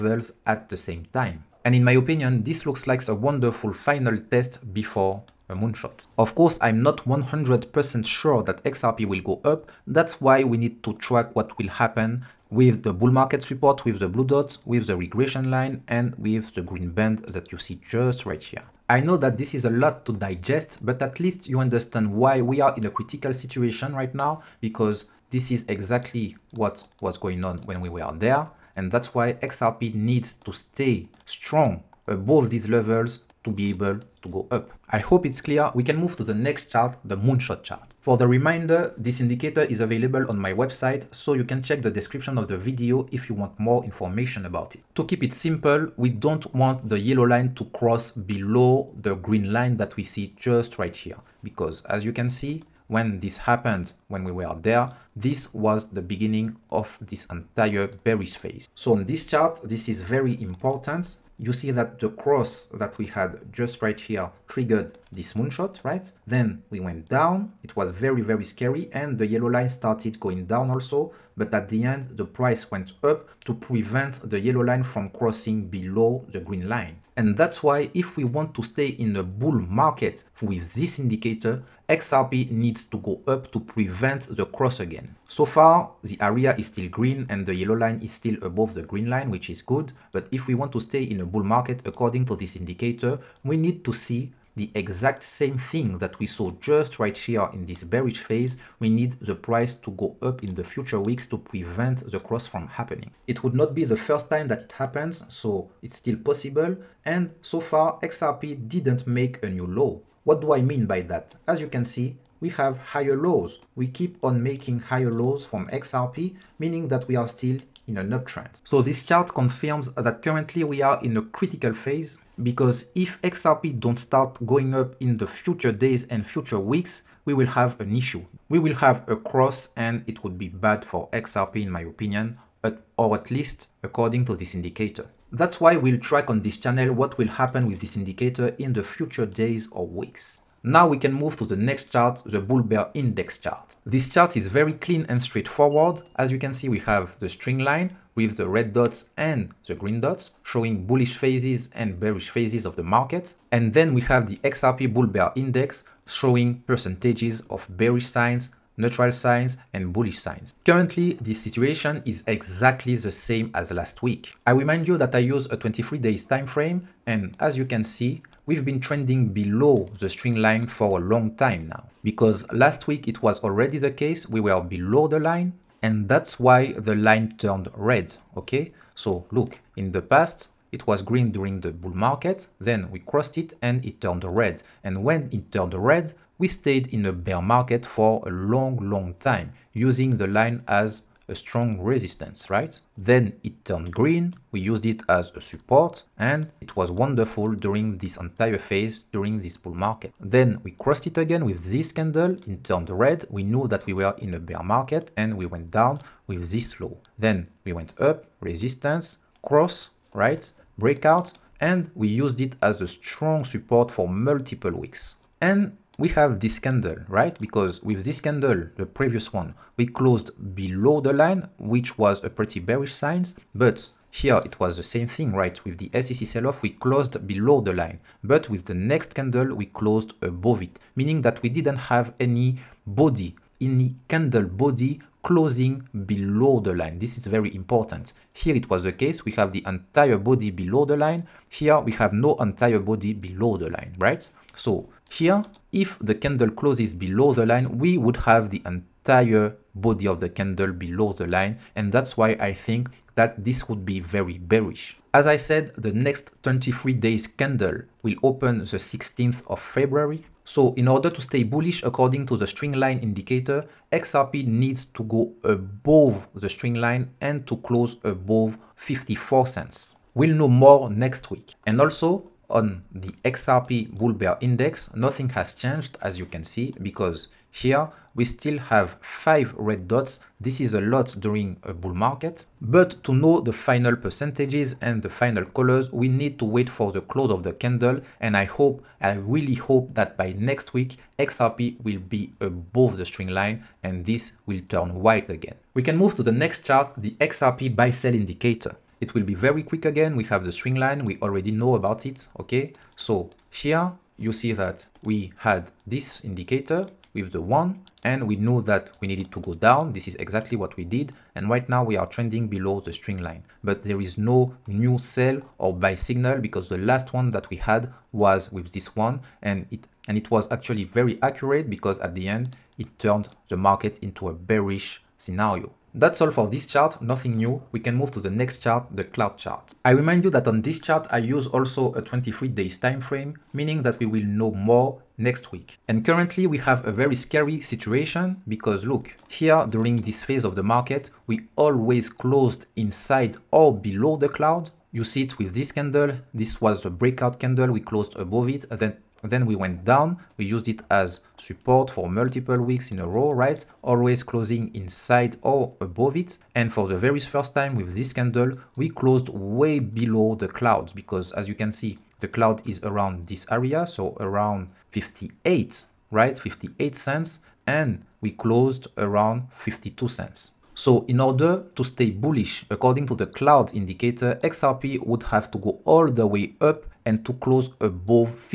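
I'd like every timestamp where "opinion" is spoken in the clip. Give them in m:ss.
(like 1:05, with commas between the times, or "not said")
0:01, 2:11.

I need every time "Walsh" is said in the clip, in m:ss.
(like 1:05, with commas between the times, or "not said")
not said.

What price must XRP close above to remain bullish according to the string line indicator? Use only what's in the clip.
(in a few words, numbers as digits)
54 cents.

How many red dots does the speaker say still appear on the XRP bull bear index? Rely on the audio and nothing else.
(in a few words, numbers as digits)
5.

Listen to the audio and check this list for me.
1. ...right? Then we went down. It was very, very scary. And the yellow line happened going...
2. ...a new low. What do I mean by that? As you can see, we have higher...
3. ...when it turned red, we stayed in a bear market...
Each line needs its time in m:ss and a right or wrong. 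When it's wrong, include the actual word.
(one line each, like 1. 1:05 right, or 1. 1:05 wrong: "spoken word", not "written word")
1. 1:05 wrong: "started", not "happened"
2. 1:49 right
3. 3:05 right.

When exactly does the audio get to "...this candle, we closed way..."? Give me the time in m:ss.
5:57.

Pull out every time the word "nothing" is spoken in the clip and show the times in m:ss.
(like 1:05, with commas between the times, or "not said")
4:34, 5:27.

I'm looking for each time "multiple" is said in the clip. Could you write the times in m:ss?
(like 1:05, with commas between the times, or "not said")
3:34, 5:52.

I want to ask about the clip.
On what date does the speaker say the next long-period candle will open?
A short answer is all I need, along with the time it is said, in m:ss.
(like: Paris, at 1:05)
16th of February, at 4:18.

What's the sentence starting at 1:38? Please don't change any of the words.
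We need the price to go up in the future weeks to prevent the cross from happening.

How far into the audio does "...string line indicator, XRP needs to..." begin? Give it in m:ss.
4:22.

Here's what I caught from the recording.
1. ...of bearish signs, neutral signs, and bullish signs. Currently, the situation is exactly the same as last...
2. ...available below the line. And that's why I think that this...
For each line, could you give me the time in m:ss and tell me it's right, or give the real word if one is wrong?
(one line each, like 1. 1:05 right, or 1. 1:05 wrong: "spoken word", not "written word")
1. 2:37 right
2. 4:10 wrong: "candle", not "available".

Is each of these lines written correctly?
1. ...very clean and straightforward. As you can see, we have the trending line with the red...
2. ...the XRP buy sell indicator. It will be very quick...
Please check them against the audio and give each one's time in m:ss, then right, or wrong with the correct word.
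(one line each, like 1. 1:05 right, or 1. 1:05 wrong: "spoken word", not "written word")
1. 2:24 wrong: "string", not "trending"
2. 4:56 right.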